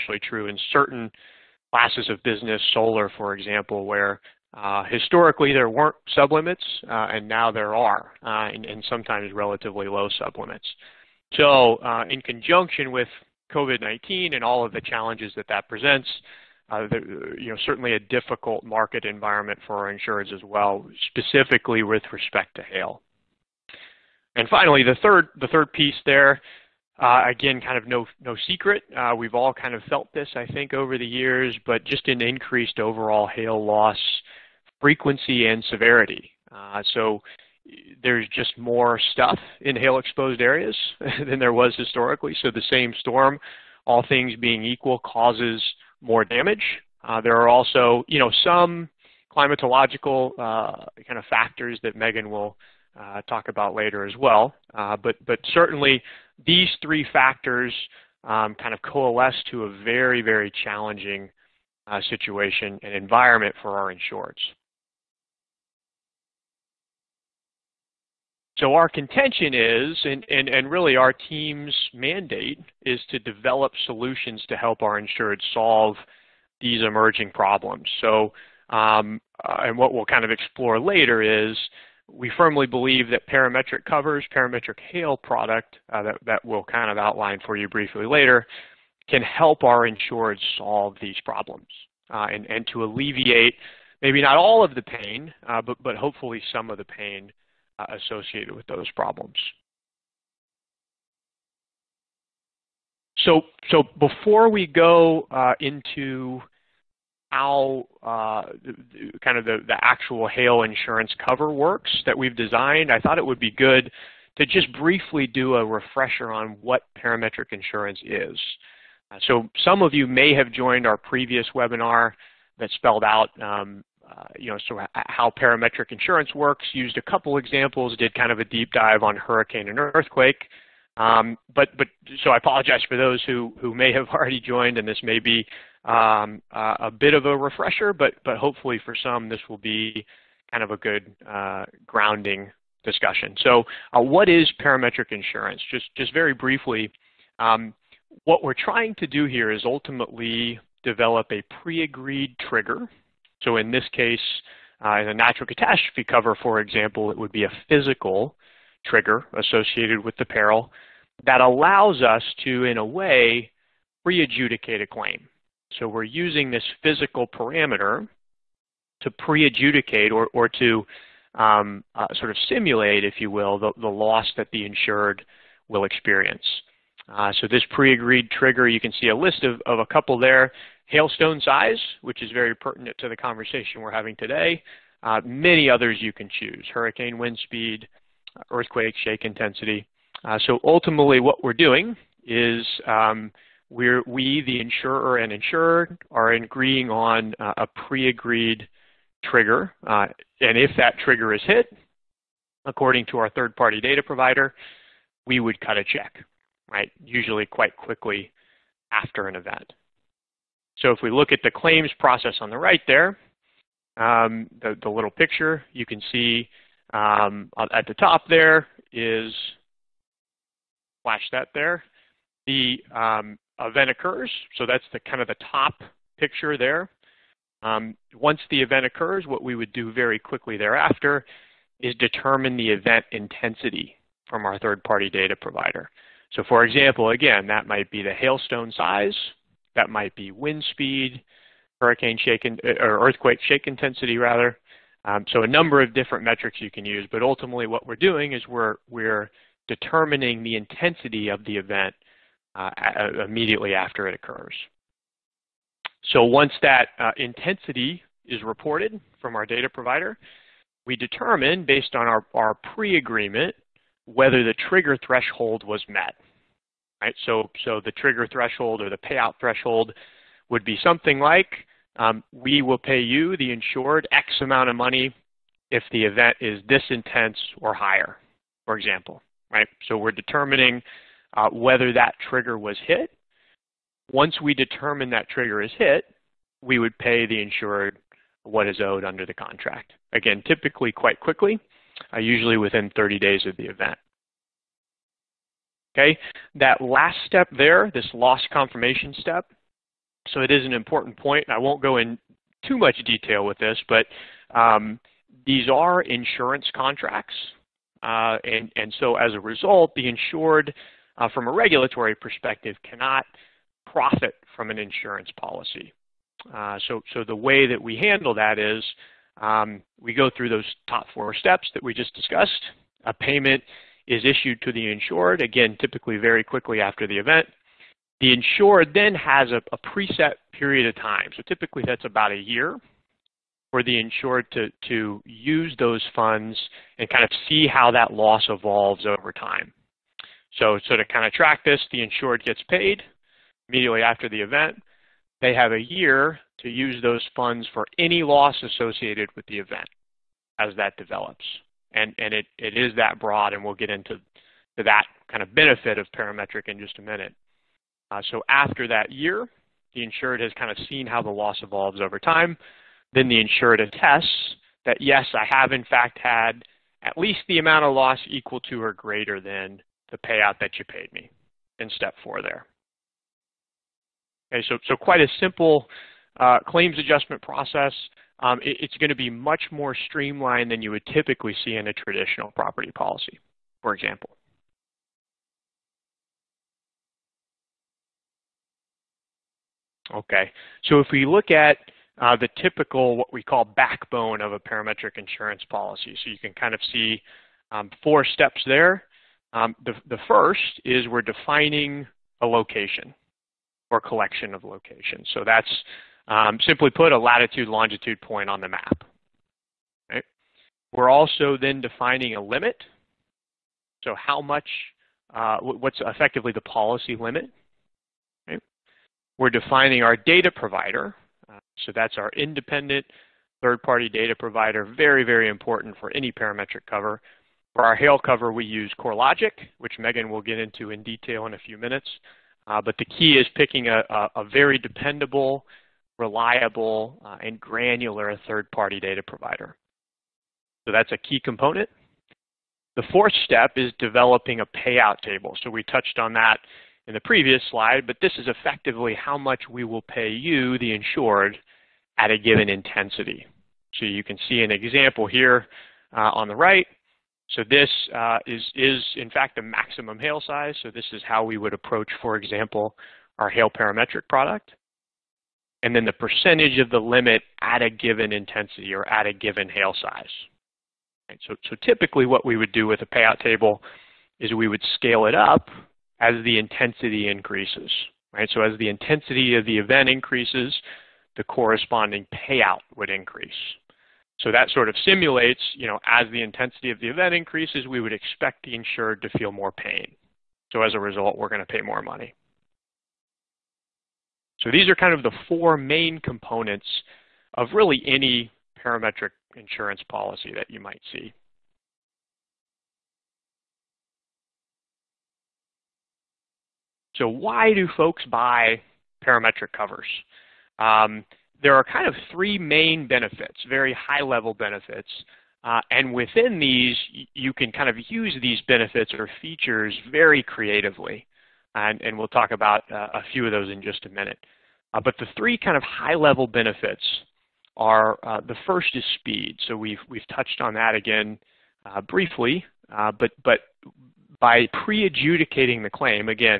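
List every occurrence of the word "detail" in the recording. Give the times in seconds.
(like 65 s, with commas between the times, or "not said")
303 s, 431 s.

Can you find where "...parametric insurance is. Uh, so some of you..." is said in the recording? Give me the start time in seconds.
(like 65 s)
116 s.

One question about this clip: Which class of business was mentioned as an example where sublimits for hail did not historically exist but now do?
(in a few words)
Solar.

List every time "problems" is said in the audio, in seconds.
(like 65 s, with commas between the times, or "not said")
77 s, 91 s, 98 s.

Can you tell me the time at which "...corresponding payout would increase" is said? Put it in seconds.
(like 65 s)
481 s.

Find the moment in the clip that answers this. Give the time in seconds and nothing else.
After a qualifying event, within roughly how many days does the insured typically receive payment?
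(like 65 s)
292 s.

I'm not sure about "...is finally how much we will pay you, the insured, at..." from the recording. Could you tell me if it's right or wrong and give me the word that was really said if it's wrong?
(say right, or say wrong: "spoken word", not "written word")
wrong: "effectively", not "finally".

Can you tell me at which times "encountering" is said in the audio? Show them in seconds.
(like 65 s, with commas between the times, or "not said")
not said.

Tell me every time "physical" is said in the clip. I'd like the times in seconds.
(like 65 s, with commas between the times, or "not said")
157 s, 166 s.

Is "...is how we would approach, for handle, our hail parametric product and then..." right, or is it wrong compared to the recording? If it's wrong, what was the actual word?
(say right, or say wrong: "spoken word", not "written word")
wrong: "example", not "handle".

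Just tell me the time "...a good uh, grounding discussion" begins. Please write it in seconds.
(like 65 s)
140 s.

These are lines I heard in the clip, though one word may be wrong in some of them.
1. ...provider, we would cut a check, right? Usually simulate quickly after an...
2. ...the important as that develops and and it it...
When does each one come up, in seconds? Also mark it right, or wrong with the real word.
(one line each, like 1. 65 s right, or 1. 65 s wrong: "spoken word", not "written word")
1. 204 s wrong: "quite", not "simulate"
2. 349 s wrong: "event", not "important".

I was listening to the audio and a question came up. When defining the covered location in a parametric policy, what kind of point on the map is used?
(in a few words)
Latitude longitude point.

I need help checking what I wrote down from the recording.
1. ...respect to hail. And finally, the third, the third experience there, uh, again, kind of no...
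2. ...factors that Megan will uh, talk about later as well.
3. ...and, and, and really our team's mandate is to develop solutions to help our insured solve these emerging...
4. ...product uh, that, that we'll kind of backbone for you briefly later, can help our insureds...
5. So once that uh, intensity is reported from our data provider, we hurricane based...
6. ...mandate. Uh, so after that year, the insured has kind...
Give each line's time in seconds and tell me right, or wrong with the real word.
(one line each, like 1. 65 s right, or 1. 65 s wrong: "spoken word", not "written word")
1. 22 s wrong: "piece", not "experience"
2. 51 s right
3. 70 s right
4. 85 s wrong: "outline", not "backbone"
5. 256 s wrong: "determine", not "hurricane"
6. 357 s wrong: "minute", not "mandate".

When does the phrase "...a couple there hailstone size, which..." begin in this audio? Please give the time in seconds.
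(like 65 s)
179 s.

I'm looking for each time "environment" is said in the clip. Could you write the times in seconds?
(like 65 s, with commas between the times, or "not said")
19 s, 62 s.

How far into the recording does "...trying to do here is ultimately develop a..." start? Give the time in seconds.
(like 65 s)
148 s.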